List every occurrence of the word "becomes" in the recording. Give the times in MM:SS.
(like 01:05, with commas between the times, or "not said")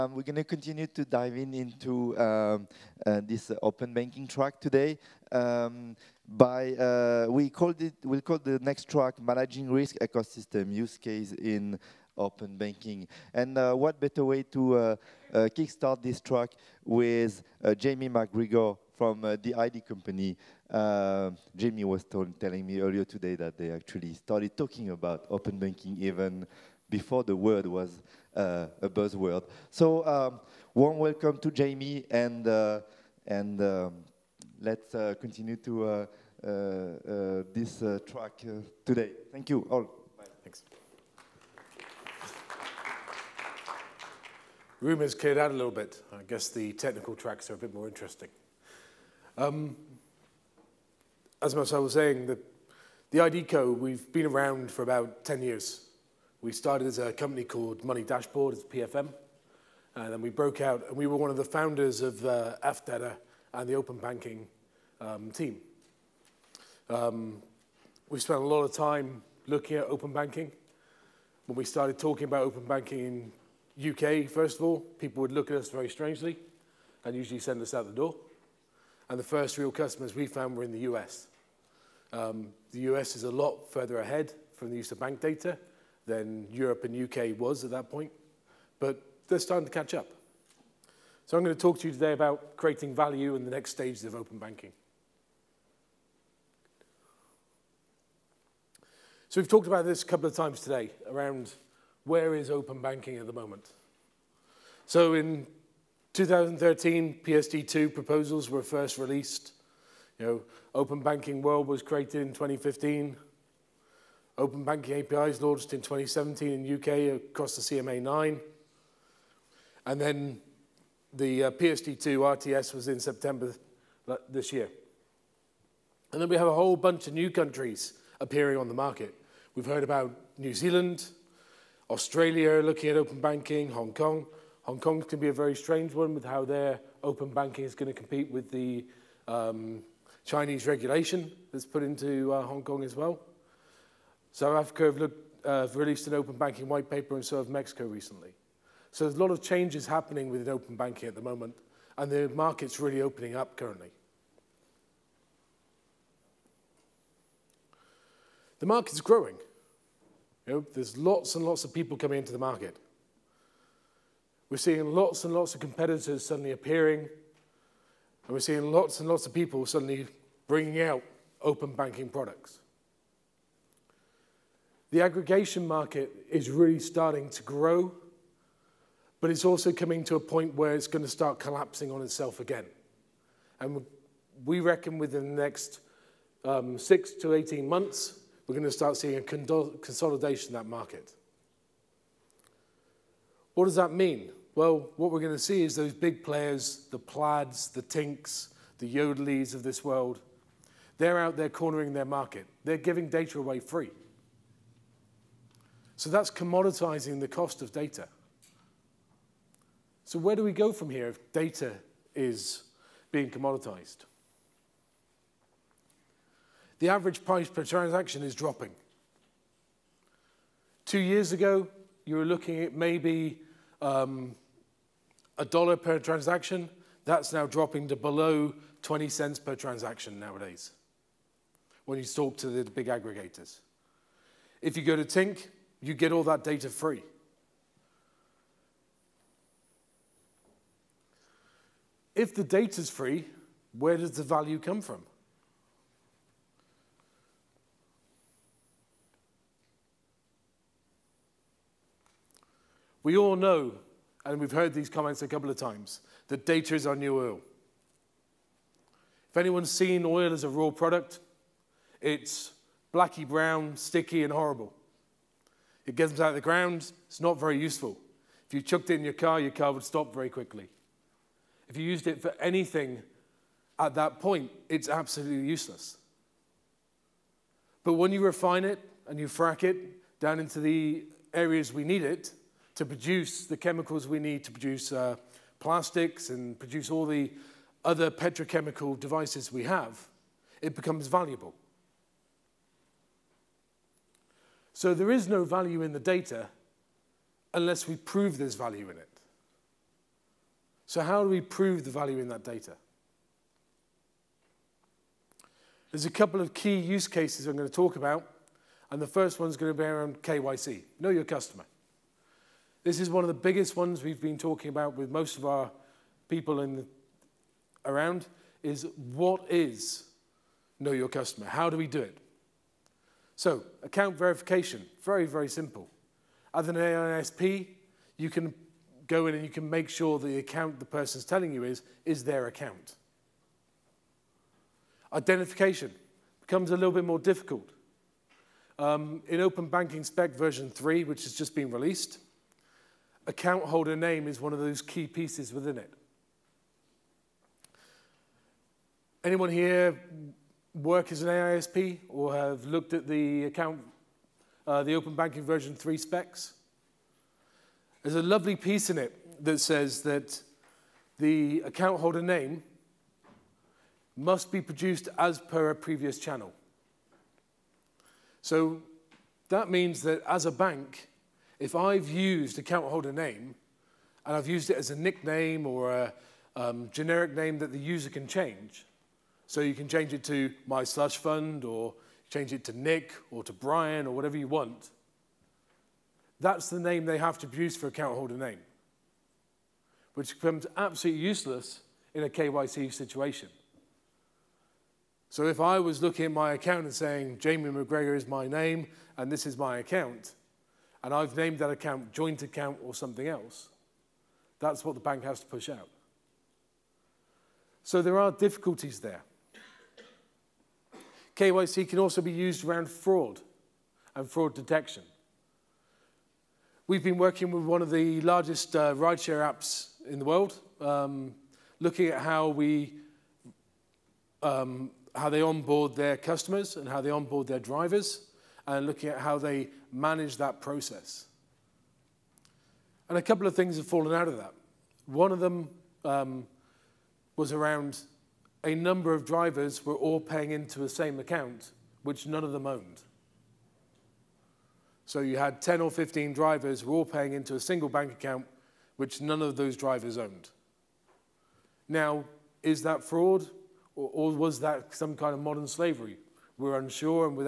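04:50, 05:36, 06:30.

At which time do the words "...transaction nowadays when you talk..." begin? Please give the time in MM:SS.
03:49.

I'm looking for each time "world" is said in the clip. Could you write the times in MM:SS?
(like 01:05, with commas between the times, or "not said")
01:51, 03:19, 07:00.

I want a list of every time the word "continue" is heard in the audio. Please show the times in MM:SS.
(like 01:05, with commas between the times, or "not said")
00:00, 00:35.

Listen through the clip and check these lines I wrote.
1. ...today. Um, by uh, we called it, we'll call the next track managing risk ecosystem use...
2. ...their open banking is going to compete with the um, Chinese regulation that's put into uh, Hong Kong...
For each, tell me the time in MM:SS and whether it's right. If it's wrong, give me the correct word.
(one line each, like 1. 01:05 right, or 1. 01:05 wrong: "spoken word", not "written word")
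1. 00:04 right
2. 02:16 right.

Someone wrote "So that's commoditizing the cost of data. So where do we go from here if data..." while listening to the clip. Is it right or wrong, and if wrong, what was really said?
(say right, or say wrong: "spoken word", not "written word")
right.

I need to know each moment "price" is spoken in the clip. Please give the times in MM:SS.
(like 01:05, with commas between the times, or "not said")
03:37.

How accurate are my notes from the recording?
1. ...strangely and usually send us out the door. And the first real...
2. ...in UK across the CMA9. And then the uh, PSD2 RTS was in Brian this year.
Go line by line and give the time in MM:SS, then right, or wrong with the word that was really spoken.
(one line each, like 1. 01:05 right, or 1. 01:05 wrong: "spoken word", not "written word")
1. 01:15 right
2. 01:56 wrong: "September", not "Brian".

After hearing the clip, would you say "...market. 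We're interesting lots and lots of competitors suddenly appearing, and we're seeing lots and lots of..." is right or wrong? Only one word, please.
wrong.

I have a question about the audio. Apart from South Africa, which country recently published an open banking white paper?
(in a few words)
Mexico.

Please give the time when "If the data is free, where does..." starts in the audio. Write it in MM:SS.
04:02.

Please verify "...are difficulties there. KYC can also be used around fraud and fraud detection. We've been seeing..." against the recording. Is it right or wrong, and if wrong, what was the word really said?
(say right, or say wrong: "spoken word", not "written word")
wrong: "working", not "seeing".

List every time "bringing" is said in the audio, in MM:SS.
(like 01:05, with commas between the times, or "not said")
02:50.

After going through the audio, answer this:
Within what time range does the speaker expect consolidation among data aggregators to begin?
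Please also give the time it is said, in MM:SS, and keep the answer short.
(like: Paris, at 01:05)
6 to 18 months, at 03:06.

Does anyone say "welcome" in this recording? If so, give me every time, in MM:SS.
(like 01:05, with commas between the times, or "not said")
00:30.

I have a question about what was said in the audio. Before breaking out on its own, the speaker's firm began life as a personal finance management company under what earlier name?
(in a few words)
Money Dashboard.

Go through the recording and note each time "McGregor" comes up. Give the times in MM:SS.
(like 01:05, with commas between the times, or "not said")
00:18, 06:37.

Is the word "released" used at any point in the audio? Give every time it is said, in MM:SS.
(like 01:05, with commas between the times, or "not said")
01:48, 02:25, 05:41.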